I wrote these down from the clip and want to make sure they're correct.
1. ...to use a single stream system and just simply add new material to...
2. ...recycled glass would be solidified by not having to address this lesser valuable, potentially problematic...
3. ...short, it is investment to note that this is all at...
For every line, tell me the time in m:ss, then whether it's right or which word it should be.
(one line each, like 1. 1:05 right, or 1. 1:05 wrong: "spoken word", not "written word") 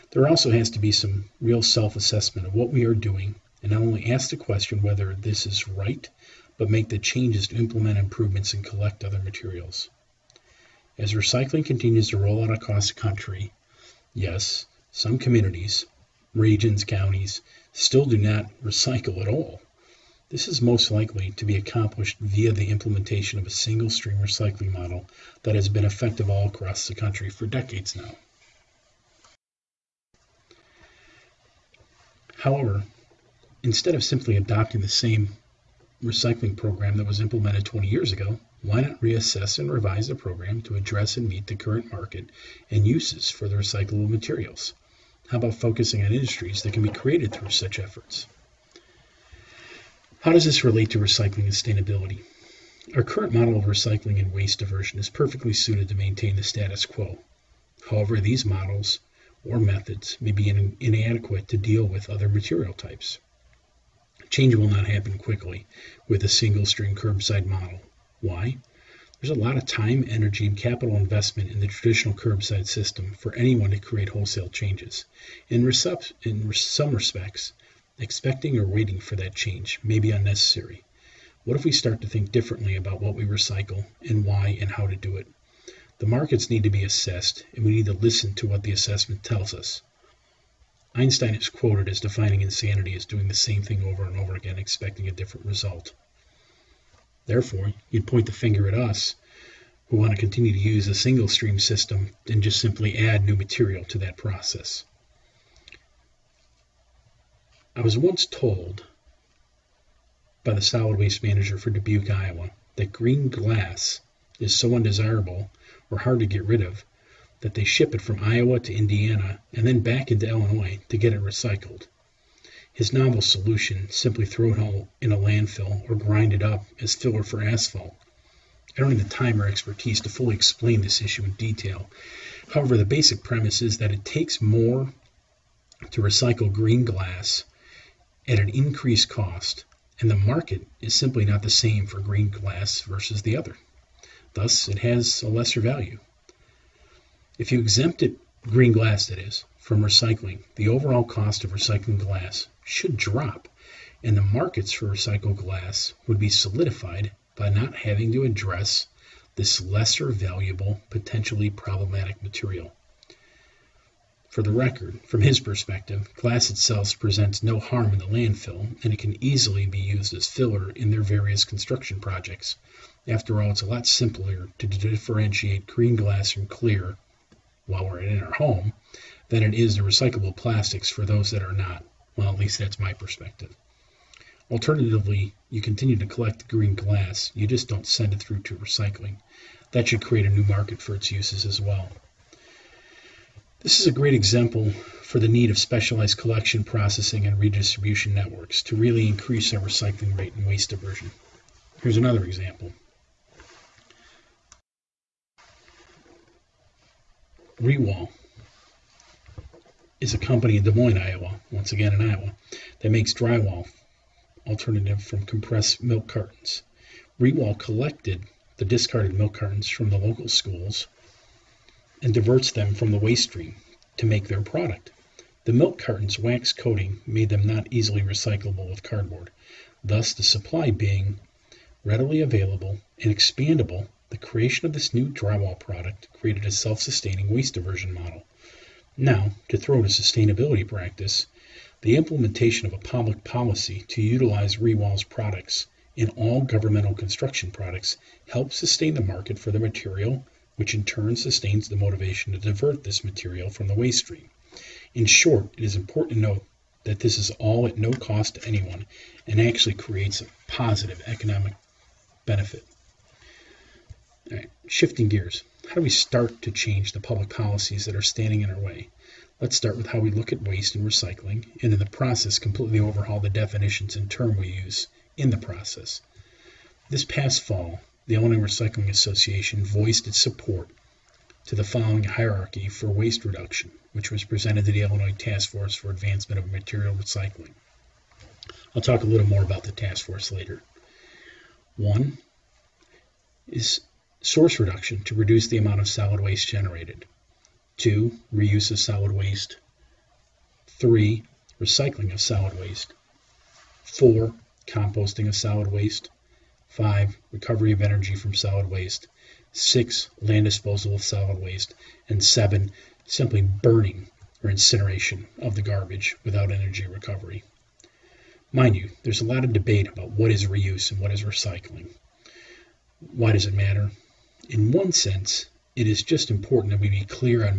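1. 1:40 right
2. 2:34 right
3. 4:15 wrong: "important", not "investment".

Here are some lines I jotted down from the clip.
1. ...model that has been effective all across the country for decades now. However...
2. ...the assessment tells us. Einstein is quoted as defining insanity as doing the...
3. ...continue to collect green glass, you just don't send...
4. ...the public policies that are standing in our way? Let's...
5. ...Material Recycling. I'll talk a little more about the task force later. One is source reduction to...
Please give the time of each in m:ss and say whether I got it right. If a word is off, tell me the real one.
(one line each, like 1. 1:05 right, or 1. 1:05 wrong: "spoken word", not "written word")
1. 0:24 right
2. 1:28 right
3. 3:05 right
4. 4:26 right
5. 4:46 right.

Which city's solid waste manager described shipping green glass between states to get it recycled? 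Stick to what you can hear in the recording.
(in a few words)
Dubuque, Iowa.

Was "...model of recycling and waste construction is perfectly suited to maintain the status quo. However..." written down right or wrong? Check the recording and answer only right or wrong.
wrong.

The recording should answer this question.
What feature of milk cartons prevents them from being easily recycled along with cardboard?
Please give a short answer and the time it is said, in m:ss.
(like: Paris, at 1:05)
wax coating, at 3:46.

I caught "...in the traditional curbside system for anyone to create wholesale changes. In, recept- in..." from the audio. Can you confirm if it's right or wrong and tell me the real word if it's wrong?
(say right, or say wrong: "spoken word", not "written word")
right.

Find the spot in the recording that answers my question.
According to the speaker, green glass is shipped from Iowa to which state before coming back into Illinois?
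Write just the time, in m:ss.
1:58.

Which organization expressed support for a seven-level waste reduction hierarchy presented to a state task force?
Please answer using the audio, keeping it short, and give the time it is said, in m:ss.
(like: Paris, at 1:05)
Illinois Recycling Association, at 4:38.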